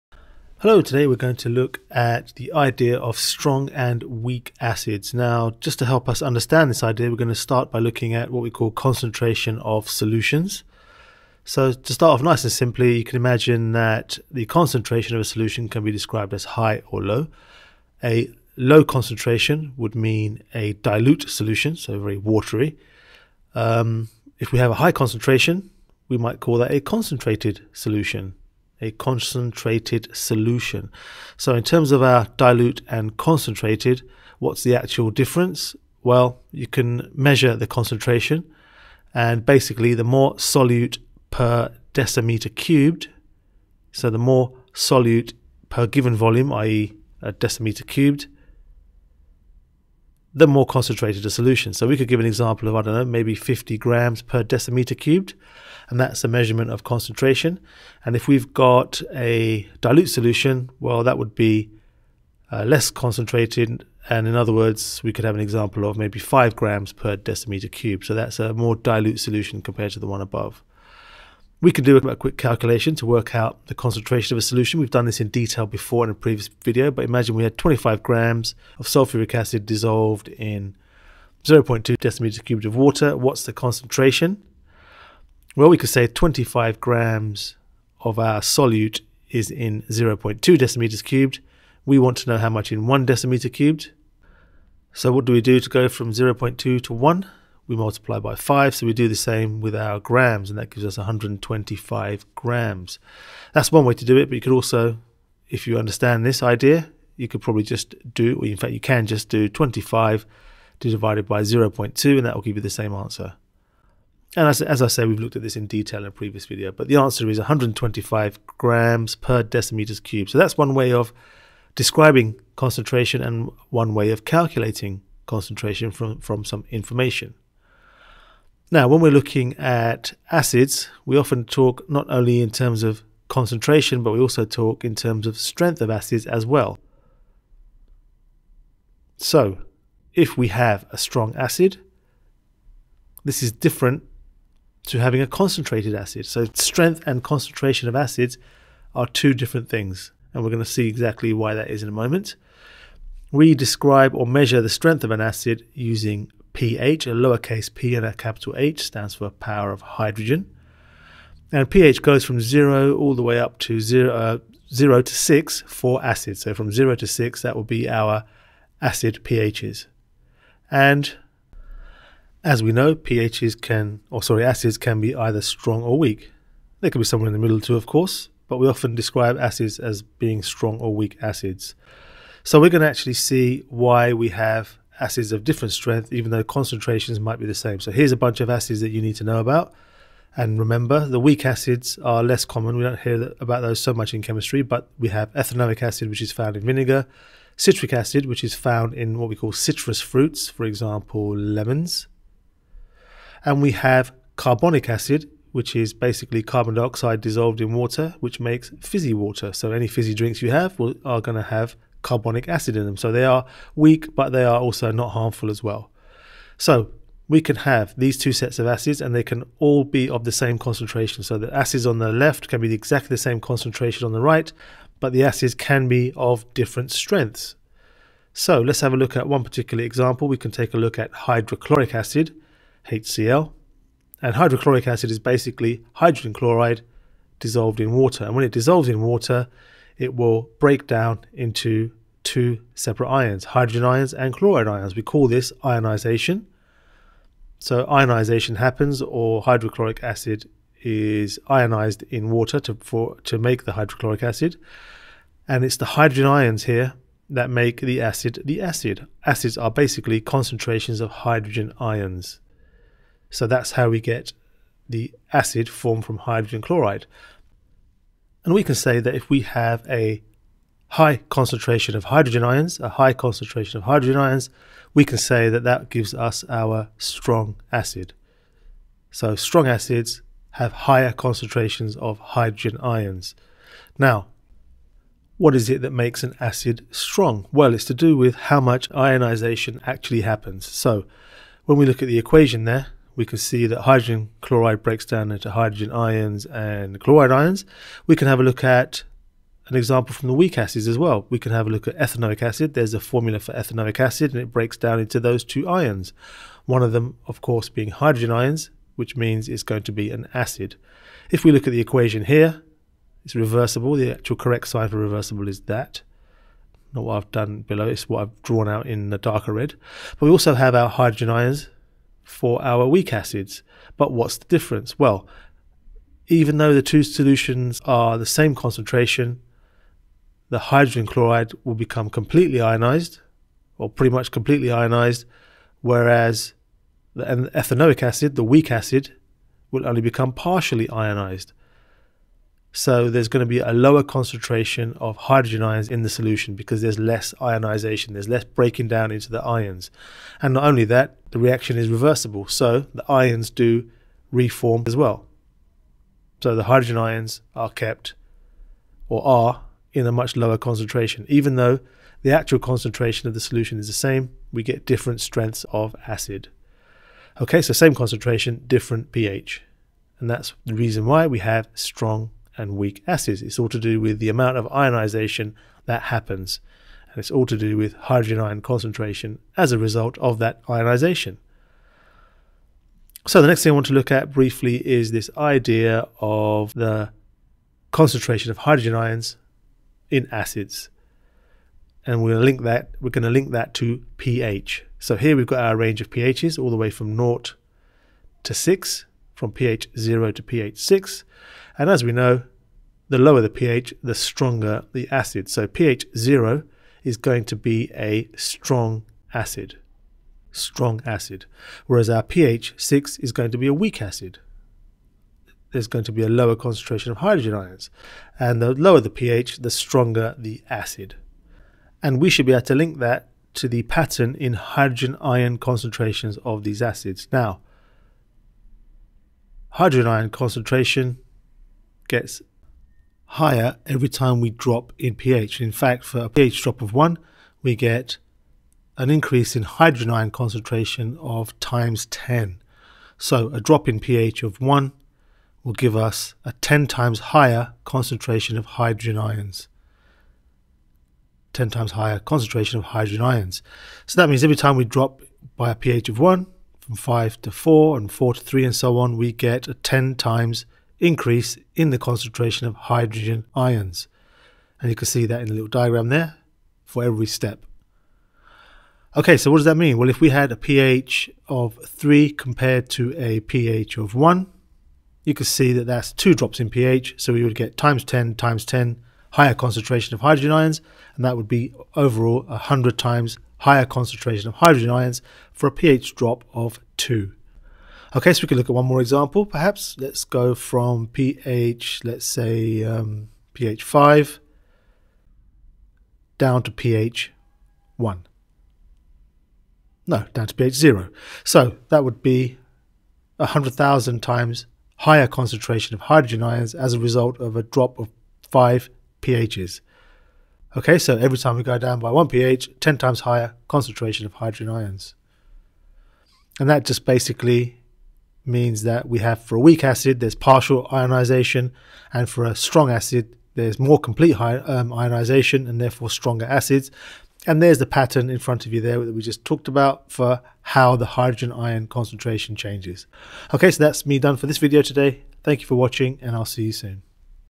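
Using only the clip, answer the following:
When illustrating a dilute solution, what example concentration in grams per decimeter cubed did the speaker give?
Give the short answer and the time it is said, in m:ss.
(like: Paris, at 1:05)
5 grams, at 1:06.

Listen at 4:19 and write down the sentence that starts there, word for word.
Acids are basically concentrations of hydrogen ions.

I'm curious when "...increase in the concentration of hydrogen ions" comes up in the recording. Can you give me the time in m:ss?
7:40.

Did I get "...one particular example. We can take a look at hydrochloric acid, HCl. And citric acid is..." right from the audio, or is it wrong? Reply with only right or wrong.
wrong.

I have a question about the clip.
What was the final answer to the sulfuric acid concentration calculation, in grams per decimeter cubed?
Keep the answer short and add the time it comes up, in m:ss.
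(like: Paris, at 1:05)
125, at 1:57.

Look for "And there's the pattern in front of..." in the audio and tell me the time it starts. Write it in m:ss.
8:47.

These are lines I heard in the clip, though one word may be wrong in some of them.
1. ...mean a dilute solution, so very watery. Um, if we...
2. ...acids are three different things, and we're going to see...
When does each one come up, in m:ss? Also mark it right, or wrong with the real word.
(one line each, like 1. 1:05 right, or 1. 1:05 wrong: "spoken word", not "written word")
1. 0:19 right
2. 2:27 wrong: "two", not "three".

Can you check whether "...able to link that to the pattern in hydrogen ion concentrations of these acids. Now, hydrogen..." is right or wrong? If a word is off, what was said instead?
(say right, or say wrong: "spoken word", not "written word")
right.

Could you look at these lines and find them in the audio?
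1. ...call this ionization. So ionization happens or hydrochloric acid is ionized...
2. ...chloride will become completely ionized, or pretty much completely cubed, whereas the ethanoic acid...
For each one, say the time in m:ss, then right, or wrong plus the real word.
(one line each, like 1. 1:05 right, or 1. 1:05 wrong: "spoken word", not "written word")
1. 4:05 right
2. 5:31 wrong: "ionized", not "cubed".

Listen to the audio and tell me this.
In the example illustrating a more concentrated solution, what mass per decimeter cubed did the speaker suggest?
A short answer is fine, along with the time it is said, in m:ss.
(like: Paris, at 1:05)
50 grams, at 0:53.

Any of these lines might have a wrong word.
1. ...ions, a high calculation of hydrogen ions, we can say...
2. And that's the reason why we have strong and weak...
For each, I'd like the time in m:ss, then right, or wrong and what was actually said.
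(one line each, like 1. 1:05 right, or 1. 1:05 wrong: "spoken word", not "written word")
1. 4:32 wrong: "concentration", not "calculation"
2. 6:10 right.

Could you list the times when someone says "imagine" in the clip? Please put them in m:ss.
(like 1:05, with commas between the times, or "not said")
0:13, 1:17.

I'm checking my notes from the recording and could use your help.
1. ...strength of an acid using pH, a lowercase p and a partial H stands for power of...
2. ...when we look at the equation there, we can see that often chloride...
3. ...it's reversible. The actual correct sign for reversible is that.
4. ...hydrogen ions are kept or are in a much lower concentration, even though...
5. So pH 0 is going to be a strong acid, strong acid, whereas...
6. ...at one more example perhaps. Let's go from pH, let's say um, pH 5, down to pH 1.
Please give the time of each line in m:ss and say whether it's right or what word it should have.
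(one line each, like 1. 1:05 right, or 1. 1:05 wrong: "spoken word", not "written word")
1. 2:34 wrong: "capital", not "partial"
2. 4:51 wrong: "hydrogen", not "often"
3. 5:13 right
4. 5:56 right
5. 6:45 right
6. 8:08 right.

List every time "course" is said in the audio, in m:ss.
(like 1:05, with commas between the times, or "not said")
2:57, 5:07.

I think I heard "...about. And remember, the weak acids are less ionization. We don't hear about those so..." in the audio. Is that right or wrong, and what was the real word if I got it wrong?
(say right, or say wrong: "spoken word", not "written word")
wrong: "common", not "ionization".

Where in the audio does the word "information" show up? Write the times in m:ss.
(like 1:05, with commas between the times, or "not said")
2:06.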